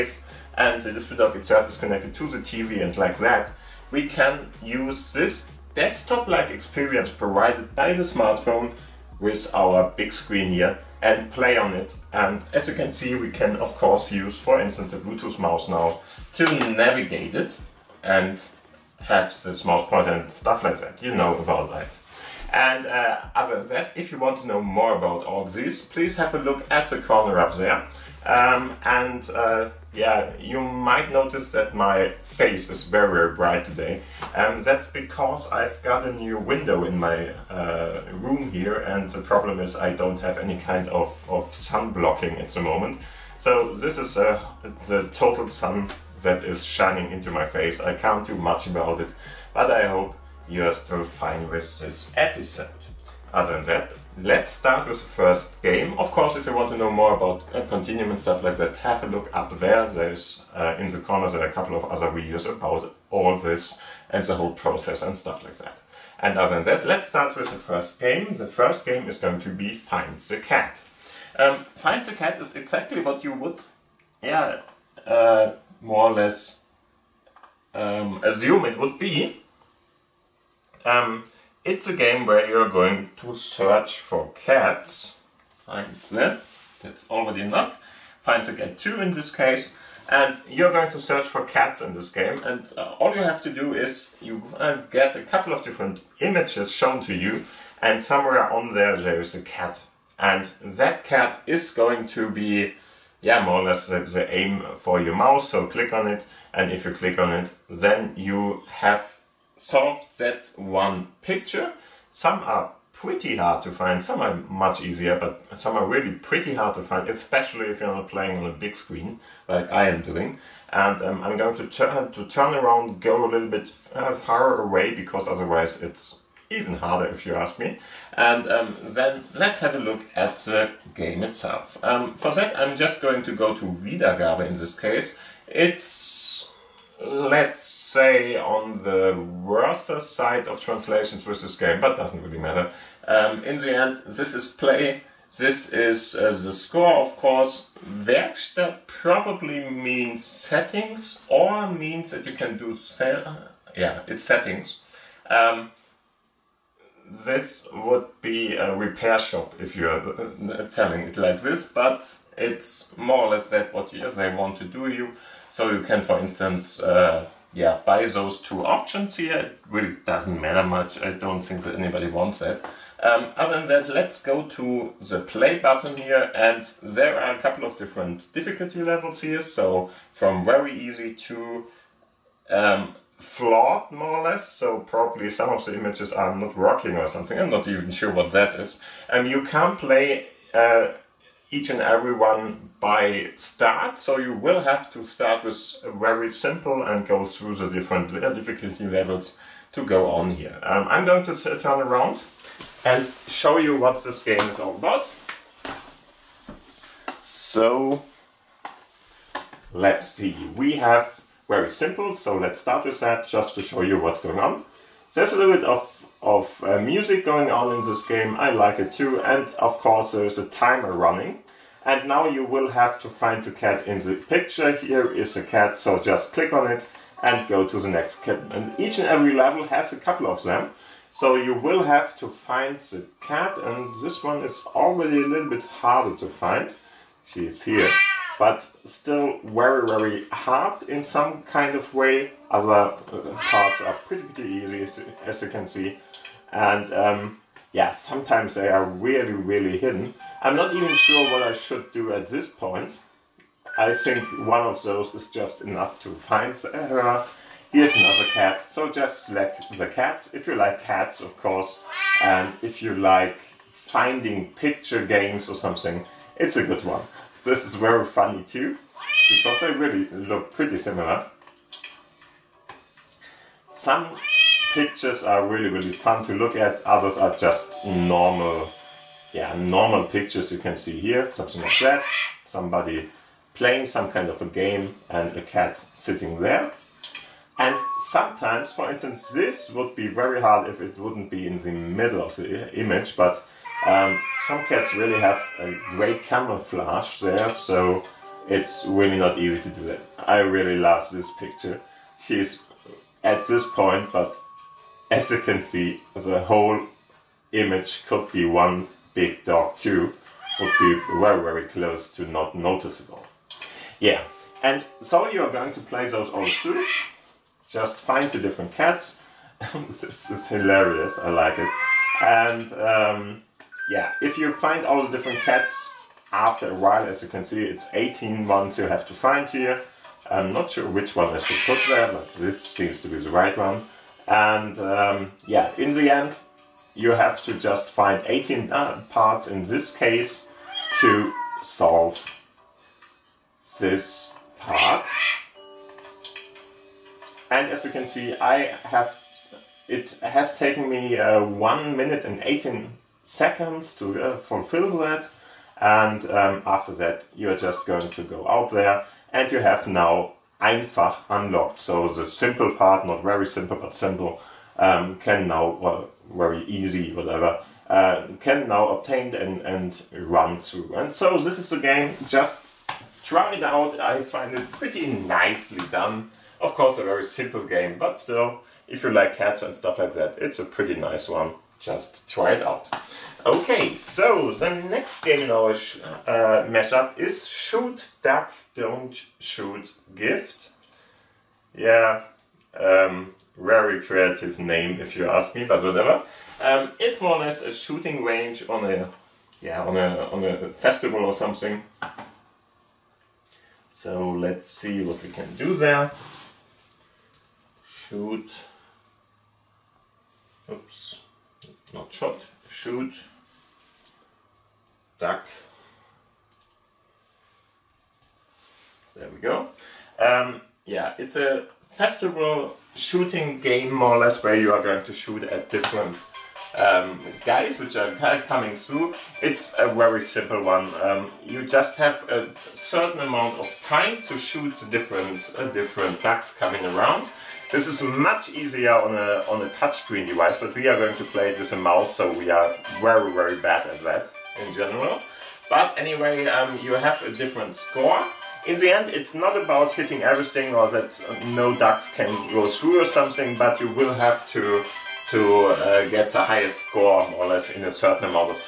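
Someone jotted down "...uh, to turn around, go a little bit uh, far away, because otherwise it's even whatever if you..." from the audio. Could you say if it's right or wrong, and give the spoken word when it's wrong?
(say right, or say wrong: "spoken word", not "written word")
wrong: "harder", not "whatever".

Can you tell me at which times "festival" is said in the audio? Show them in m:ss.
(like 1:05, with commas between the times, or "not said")
6:40, 7:01.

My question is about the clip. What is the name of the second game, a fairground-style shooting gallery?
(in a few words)
Shoot Duck Don't Shoot Gift.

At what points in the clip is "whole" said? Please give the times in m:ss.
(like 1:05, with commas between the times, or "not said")
1:04, 5:06.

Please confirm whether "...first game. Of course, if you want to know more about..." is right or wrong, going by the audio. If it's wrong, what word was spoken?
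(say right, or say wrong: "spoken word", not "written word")
right.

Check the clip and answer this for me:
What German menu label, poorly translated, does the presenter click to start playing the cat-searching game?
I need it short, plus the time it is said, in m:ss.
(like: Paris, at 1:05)
Wiedergabe, at 2:13.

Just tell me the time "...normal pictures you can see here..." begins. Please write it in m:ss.
4:39.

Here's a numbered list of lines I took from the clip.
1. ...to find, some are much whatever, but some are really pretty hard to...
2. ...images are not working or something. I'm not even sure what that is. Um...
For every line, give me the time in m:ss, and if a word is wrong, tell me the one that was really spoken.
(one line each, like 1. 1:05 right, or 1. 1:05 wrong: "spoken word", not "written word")
1. 1:53 wrong: "easier", not "whatever"
2. 3:05 right.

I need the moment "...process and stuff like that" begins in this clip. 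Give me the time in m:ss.
1:04.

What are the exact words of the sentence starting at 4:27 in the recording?
This is very funny too, because they really look pretty similar.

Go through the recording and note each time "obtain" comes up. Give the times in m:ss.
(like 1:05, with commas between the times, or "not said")
6:08.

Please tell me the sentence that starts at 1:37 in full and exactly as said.
And somewhere on there, there is a cat.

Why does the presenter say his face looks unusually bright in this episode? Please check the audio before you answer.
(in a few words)
A new window.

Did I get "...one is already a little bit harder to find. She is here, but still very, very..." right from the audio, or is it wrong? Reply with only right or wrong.
right.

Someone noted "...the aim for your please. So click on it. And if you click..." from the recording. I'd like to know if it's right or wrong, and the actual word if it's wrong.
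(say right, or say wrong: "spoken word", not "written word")
wrong: "mouse", not "please".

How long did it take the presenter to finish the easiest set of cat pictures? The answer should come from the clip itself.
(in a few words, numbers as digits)
1 minute 18 seconds.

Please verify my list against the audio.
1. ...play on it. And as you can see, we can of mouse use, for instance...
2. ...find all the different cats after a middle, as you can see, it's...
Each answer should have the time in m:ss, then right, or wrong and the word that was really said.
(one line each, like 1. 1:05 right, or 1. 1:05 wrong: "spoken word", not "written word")
1. 0:11 wrong: "course", not "mouse"
2. 5:24 wrong: "while", not "middle".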